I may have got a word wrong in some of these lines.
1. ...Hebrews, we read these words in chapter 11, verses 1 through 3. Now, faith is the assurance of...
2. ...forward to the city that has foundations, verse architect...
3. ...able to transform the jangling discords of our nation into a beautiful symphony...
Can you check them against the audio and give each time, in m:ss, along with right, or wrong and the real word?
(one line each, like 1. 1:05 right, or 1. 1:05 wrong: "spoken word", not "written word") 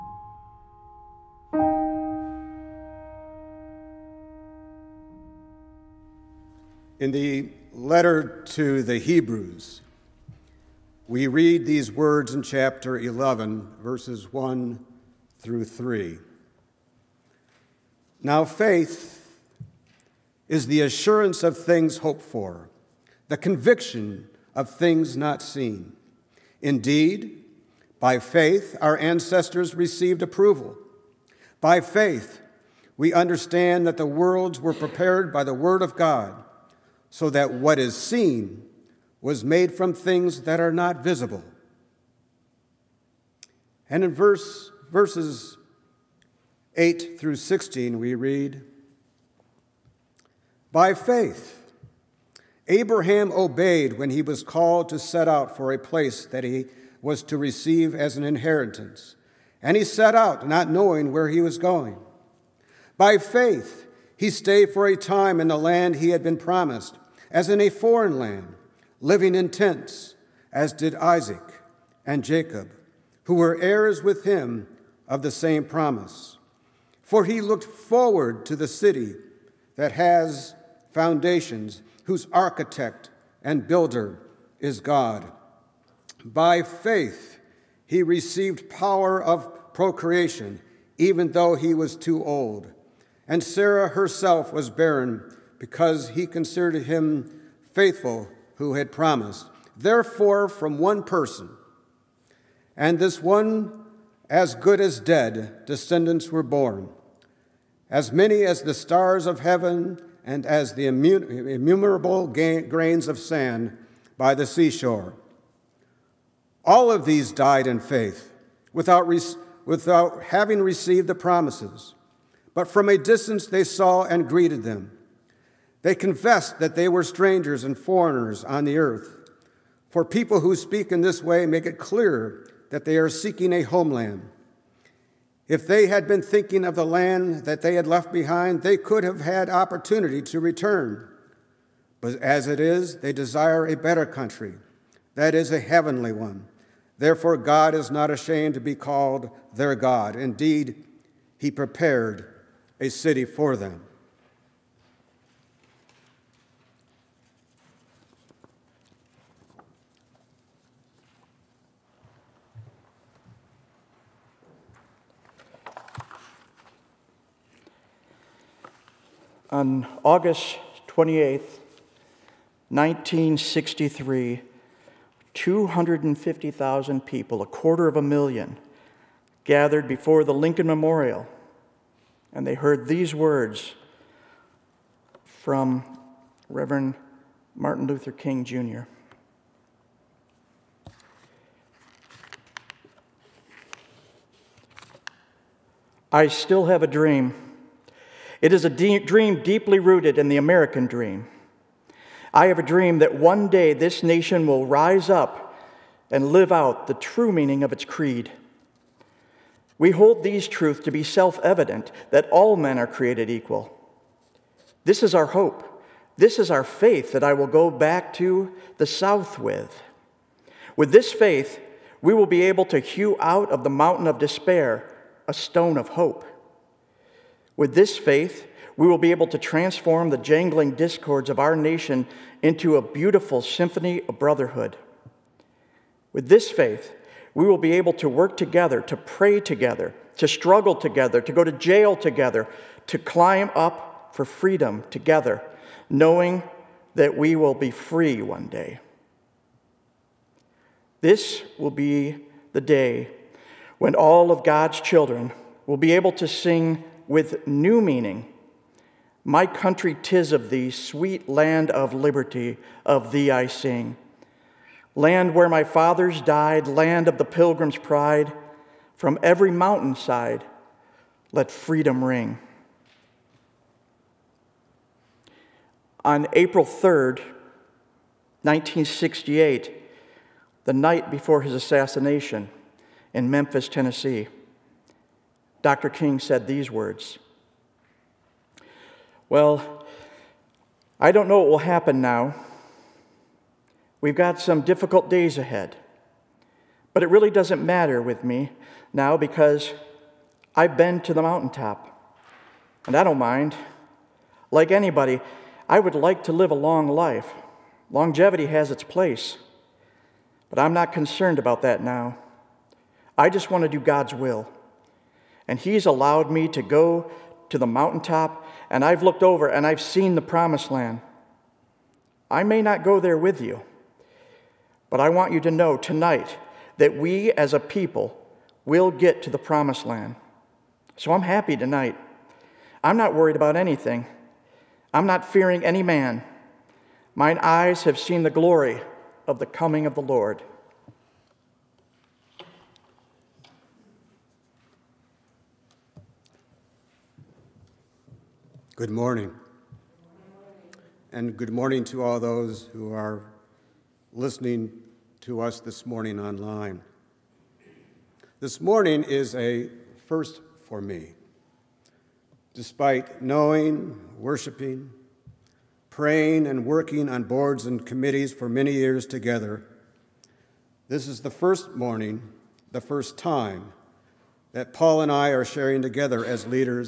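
1. 0:08 right
2. 1:17 wrong: "whose", not "verse"
3. 3:49 right.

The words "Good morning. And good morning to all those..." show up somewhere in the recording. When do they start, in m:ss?
5:48.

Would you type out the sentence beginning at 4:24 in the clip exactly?
Land where my fathers died, land of the pilgrim's pride, from every mountainside, let freedom ring.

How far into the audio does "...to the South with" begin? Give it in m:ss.
3:38.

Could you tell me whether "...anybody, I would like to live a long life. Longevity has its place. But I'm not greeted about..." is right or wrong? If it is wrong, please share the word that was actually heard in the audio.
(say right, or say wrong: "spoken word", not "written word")
wrong: "concerned", not "greeted".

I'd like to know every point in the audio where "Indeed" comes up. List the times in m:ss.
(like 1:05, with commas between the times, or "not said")
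0:26, 2:30.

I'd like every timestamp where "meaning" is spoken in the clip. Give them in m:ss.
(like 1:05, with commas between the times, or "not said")
3:27, 4:17.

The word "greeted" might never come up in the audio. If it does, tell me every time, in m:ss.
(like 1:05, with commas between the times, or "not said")
2:04.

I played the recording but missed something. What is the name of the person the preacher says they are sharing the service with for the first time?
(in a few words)
Paul.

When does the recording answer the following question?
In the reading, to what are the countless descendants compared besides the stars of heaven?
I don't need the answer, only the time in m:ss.
1:52.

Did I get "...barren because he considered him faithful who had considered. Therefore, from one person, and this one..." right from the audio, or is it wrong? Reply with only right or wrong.
wrong.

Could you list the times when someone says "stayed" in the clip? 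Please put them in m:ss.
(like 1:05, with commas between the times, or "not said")
1:04.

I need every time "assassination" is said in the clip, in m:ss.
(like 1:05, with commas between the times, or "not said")
4:41.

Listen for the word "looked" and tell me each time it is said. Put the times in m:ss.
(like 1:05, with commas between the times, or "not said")
1:17, 5:19.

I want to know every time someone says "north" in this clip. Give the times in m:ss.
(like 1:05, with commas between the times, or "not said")
not said.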